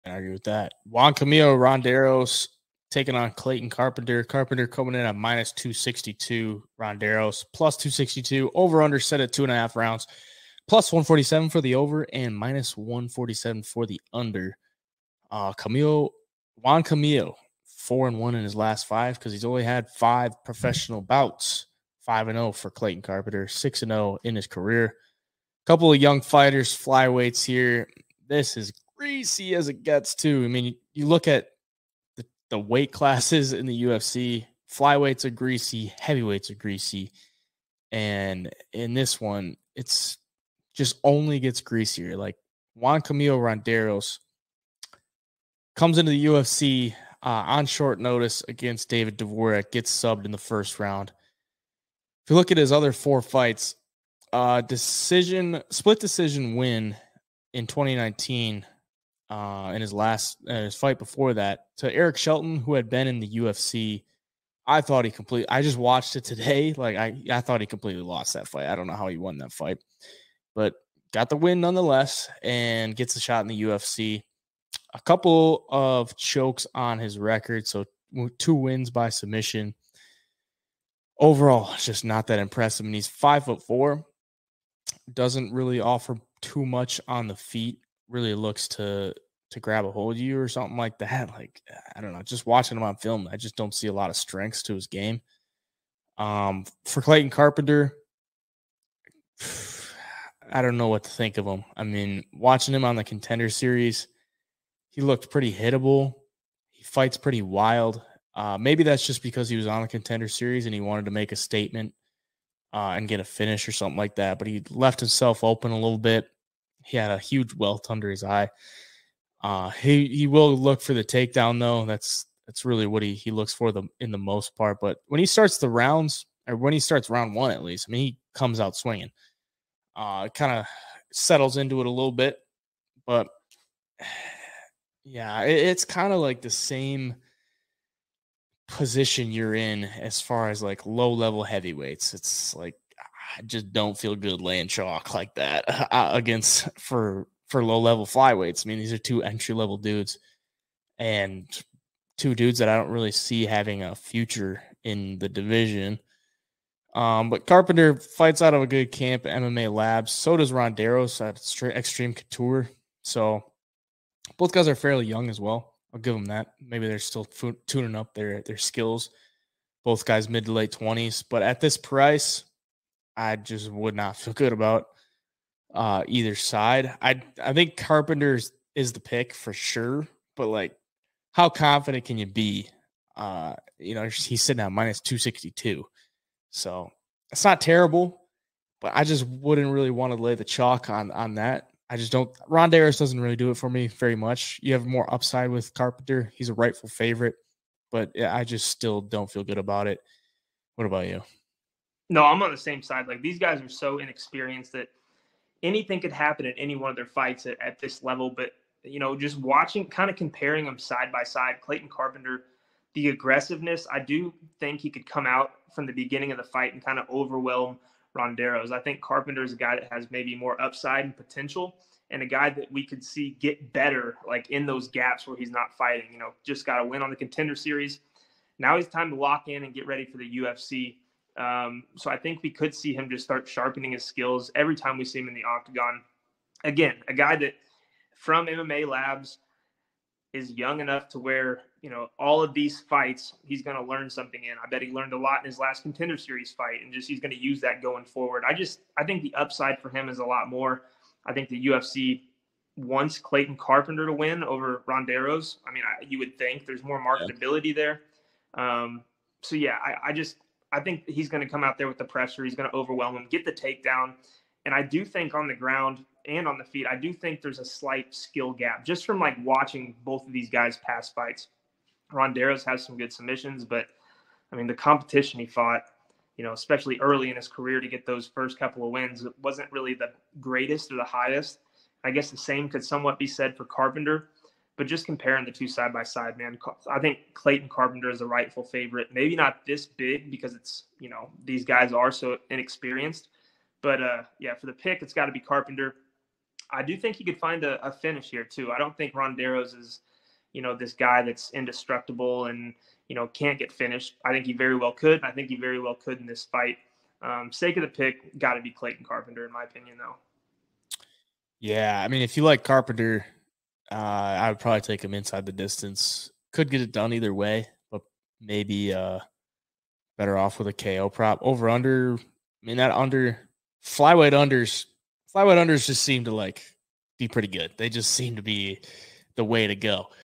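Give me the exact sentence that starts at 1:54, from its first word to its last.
But he left himself open a little bit he had a huge welt under his eye.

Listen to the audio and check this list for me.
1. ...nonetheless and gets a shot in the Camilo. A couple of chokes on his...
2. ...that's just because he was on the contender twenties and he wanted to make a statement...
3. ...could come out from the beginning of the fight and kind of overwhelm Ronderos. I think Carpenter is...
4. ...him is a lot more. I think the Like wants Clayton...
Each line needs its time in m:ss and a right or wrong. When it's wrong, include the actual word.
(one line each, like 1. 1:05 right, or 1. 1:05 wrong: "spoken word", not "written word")
1. 1:11 wrong: "UFC", not "Camilo"
2. 1:48 wrong: "series", not "twenties"
3. 3:34 right
4. 4:09 wrong: "UFC", not "Like".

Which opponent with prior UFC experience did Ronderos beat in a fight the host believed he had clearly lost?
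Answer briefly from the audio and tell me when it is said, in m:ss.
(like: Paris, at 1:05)
Eric Shelton, at 1:01.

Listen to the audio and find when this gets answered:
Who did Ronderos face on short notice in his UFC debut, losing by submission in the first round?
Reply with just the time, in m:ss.
0:48.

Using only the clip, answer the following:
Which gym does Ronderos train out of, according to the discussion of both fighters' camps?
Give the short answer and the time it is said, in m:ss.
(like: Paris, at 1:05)
Extreme Couture, at 2:41.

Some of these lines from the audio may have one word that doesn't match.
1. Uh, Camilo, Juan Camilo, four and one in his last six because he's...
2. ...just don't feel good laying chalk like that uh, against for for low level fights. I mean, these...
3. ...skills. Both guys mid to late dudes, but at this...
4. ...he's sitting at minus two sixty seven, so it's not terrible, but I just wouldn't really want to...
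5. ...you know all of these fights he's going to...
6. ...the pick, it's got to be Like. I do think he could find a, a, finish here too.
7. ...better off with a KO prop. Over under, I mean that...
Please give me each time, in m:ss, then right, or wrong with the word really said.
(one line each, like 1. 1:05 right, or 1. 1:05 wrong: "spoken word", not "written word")
1. 0:15 wrong: "five", not "six"
2. 2:23 wrong: "flyweights", not "fights"
3. 2:48 wrong: "twenties", not "dudes"
4. 3:04 wrong: "two", not "seven"
5. 4:01 right
6. 4:54 wrong: "Carpenter", not "Like"
7. 5:20 right.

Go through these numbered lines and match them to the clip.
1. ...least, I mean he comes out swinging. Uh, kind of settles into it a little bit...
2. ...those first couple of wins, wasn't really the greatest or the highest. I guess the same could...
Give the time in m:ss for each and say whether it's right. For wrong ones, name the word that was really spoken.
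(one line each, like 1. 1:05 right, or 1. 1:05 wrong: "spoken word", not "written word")
1. 2:07 right
2. 4:38 right.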